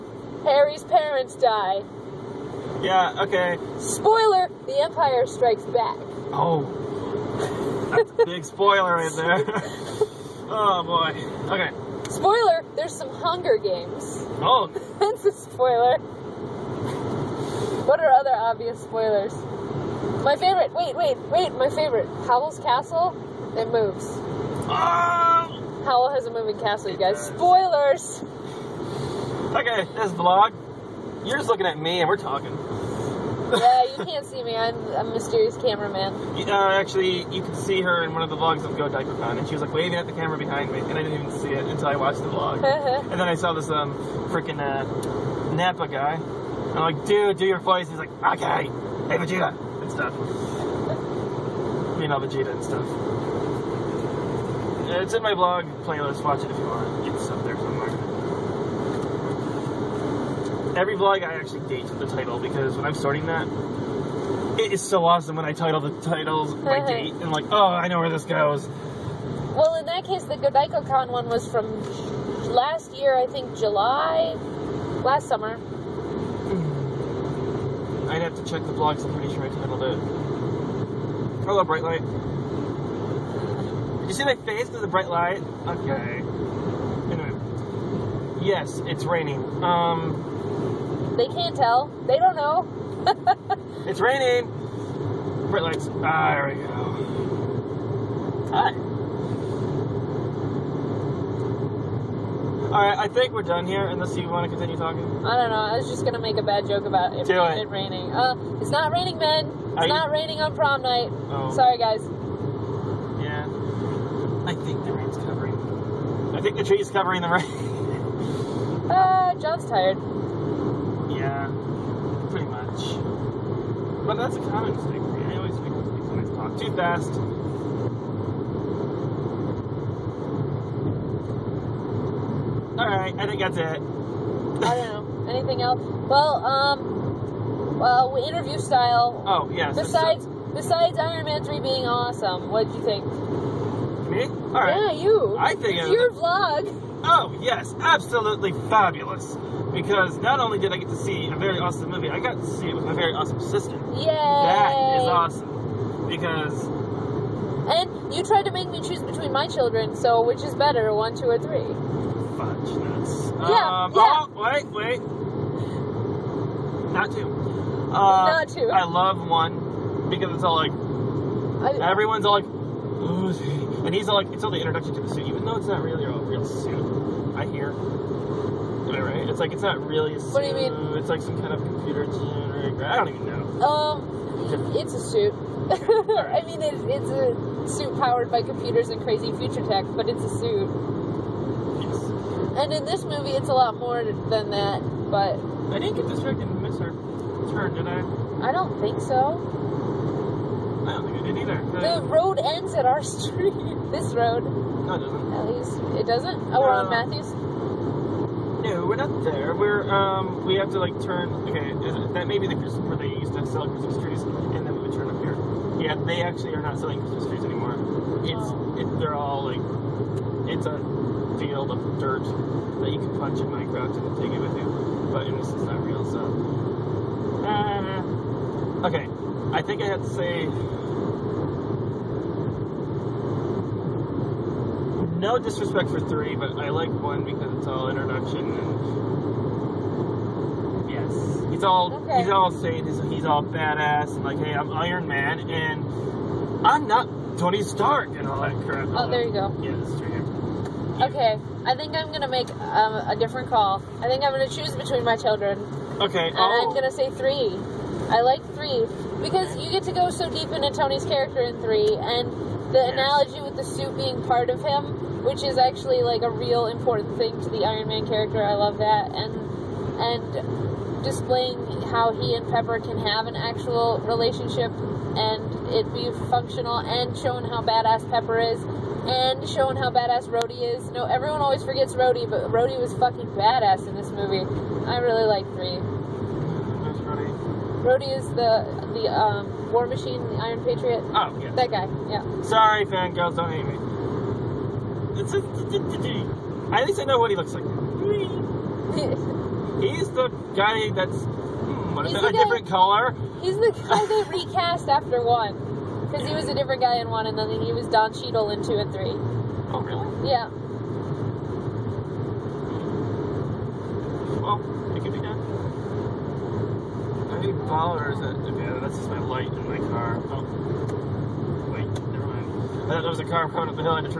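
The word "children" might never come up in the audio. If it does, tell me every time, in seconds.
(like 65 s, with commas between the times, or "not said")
159 s, 255 s.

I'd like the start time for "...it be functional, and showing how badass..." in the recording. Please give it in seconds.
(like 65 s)
275 s.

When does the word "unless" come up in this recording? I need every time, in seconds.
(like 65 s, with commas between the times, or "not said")
103 s.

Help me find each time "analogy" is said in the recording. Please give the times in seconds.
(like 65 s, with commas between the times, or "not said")
262 s.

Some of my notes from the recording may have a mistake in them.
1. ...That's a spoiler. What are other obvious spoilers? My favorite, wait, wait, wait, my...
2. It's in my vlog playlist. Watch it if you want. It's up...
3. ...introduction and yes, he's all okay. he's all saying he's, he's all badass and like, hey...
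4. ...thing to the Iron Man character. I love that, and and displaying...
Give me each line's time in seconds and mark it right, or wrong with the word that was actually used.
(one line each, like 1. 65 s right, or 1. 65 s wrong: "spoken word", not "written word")
1. 14 s right
2. 55 s right
3. 237 s right
4. 267 s right.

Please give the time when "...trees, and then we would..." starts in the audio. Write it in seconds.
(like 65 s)
213 s.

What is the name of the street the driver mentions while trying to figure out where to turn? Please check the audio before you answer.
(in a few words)
Matthews.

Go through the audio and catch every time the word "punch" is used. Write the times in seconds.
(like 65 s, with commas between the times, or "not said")
223 s.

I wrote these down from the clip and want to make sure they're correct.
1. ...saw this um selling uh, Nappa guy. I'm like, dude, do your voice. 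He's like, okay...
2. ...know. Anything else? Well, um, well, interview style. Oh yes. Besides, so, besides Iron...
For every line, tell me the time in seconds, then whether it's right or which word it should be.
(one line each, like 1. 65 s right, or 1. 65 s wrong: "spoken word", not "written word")
1. 43 s wrong: "freaking", not "selling"
2. 135 s right.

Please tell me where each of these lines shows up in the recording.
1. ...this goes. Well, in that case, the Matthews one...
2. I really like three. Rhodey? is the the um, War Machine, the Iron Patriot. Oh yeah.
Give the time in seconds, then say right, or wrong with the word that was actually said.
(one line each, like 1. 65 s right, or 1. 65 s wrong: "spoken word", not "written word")
1. 68 s wrong: "GodaikoCon", not "Matthews"
2. 284 s right.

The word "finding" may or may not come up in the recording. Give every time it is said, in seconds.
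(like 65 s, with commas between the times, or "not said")
not said.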